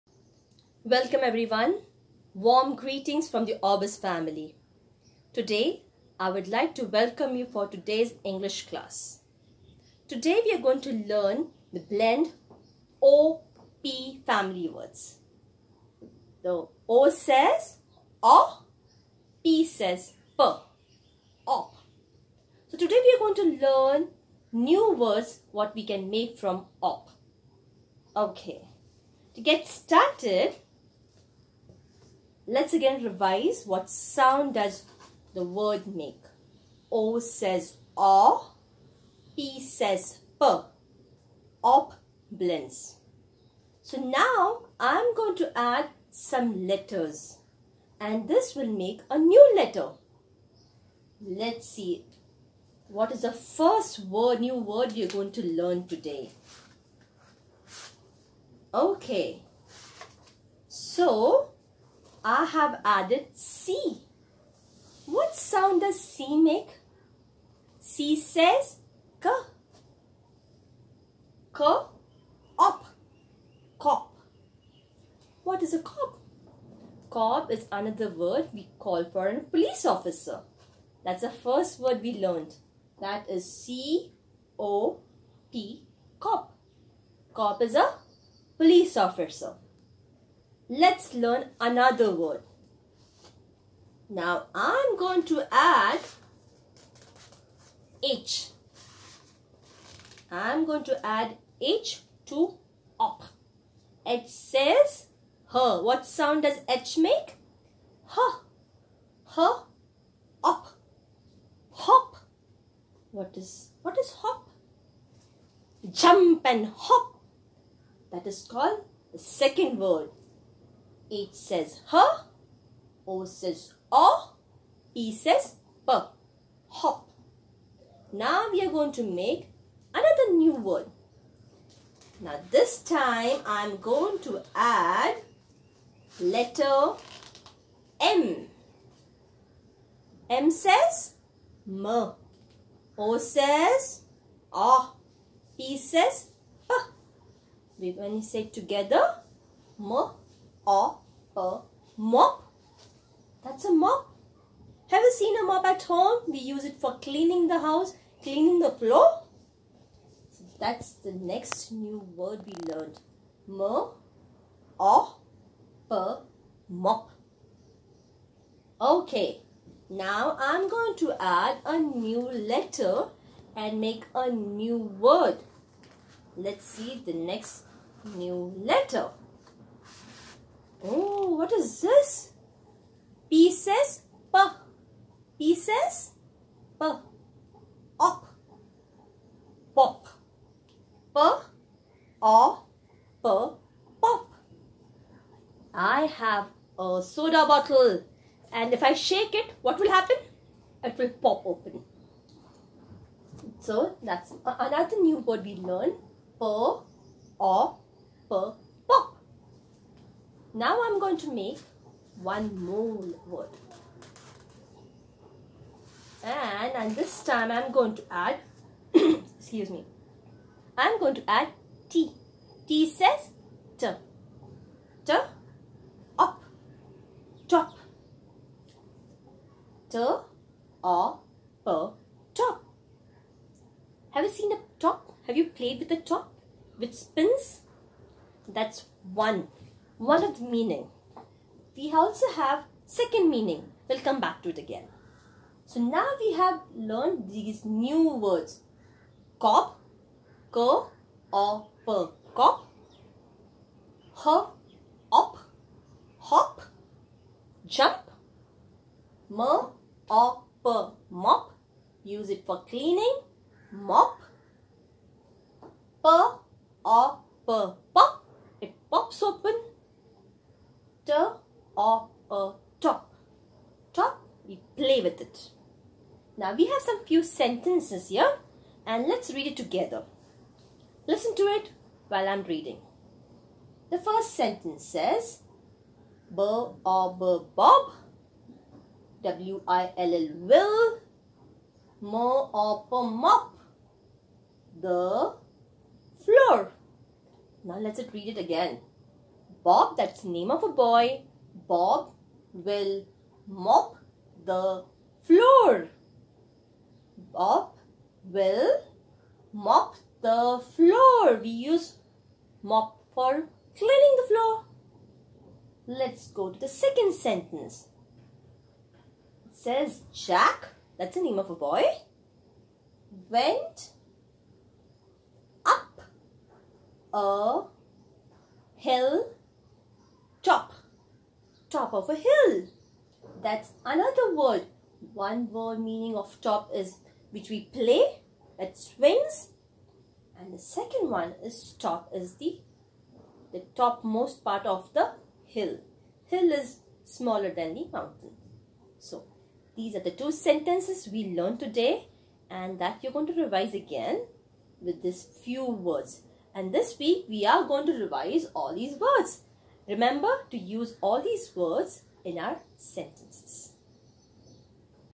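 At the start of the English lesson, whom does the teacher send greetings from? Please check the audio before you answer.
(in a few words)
Orbis.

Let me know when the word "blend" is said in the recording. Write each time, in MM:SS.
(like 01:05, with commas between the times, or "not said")
00:11, 00:42.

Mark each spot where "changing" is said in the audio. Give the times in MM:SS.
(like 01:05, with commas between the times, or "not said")
not said.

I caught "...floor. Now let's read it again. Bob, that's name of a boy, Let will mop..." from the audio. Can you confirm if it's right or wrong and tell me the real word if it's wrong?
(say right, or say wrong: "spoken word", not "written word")
wrong: "Bob", not "Let".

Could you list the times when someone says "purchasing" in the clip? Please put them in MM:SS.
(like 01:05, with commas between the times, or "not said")
not said.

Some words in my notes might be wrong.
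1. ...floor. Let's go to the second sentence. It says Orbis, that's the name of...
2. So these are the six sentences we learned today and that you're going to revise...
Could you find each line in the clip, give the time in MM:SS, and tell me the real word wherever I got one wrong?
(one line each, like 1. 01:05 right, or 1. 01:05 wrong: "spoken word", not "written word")
1. 05:14 wrong: "Jack", not "Orbis"
2. 05:48 wrong: "two", not "six".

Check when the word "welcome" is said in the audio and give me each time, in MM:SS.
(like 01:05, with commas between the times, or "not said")
00:00, 00:06.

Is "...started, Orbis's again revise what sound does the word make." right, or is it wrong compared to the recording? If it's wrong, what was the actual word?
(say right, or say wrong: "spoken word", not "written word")
wrong: "Let", not "Orbis".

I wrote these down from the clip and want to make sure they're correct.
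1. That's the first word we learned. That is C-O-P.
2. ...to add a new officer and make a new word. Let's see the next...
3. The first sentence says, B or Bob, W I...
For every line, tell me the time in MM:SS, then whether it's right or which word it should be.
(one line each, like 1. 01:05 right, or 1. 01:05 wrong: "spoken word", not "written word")
1. 01:21 right
2. 02:50 wrong: "letter", not "officer"
3. 04:43 right.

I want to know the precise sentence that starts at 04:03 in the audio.
We'll come back to it again.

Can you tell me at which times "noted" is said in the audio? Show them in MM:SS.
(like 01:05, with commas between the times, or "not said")
not said.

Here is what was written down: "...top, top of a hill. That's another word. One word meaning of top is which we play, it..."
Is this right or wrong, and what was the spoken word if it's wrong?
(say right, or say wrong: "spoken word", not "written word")
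right.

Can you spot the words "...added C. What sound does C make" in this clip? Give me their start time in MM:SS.
01:02.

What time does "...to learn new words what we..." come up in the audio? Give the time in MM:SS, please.
00:23.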